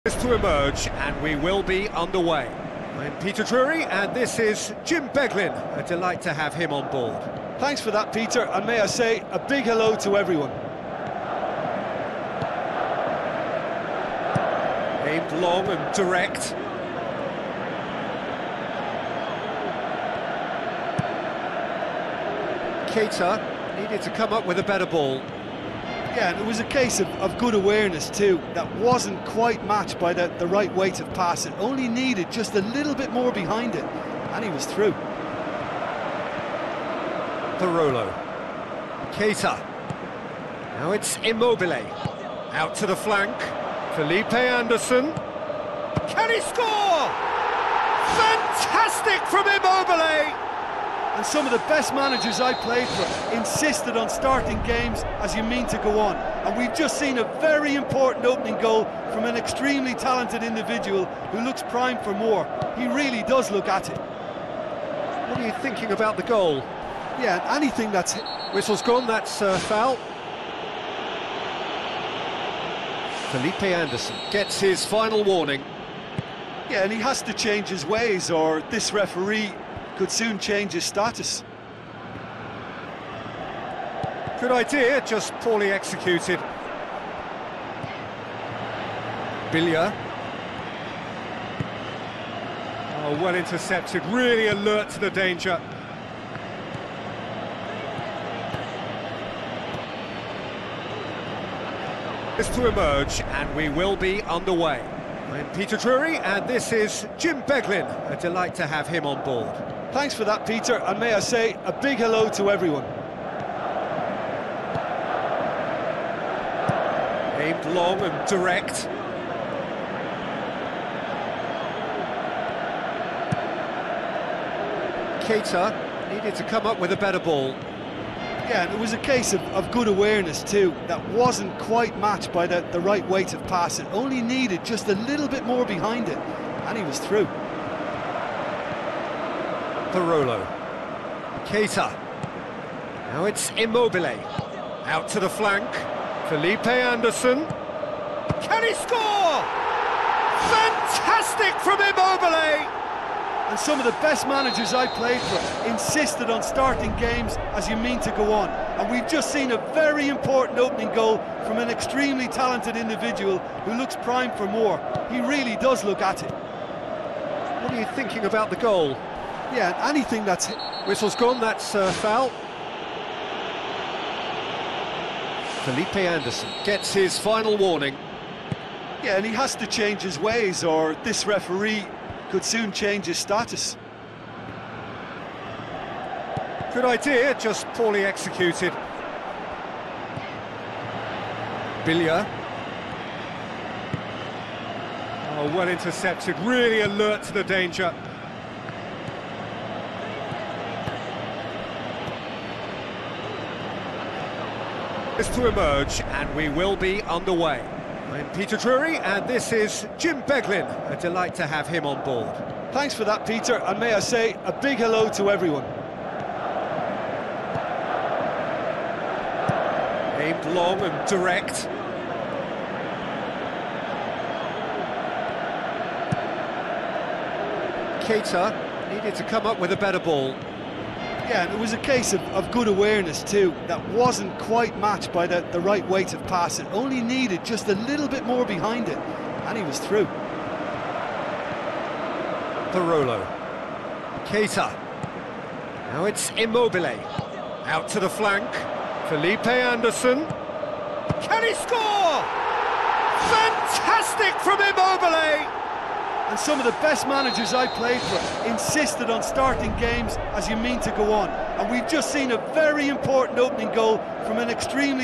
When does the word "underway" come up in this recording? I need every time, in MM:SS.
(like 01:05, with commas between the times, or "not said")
00:01, 01:44, 03:27.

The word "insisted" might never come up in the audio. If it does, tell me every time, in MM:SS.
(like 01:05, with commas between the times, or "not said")
00:53, 02:35, 04:18.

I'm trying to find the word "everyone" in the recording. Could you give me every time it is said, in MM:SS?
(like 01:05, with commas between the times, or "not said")
00:10, 01:52, 03:35.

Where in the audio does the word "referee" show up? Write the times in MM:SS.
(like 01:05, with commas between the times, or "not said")
01:18, 03:01.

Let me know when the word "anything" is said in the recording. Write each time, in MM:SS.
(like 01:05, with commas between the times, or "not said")
01:07, 02:49.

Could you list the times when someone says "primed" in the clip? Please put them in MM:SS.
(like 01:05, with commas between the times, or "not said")
01:01, 02:43.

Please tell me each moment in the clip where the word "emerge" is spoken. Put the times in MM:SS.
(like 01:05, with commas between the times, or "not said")
00:00, 01:42, 03:25.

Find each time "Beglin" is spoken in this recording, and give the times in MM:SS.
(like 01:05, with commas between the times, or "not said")
00:05, 01:47, 03:30.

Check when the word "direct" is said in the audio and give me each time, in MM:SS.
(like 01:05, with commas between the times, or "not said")
00:15, 01:58, 03:41.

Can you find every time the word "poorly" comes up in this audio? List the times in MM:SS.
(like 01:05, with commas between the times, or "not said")
01:25, 03:07.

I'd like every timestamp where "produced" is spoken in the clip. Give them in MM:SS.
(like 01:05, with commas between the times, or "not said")
not said.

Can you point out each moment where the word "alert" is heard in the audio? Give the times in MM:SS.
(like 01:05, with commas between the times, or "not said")
01:34, 03:16.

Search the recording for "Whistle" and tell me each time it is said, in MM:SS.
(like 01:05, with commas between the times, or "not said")
01:08, 02:50.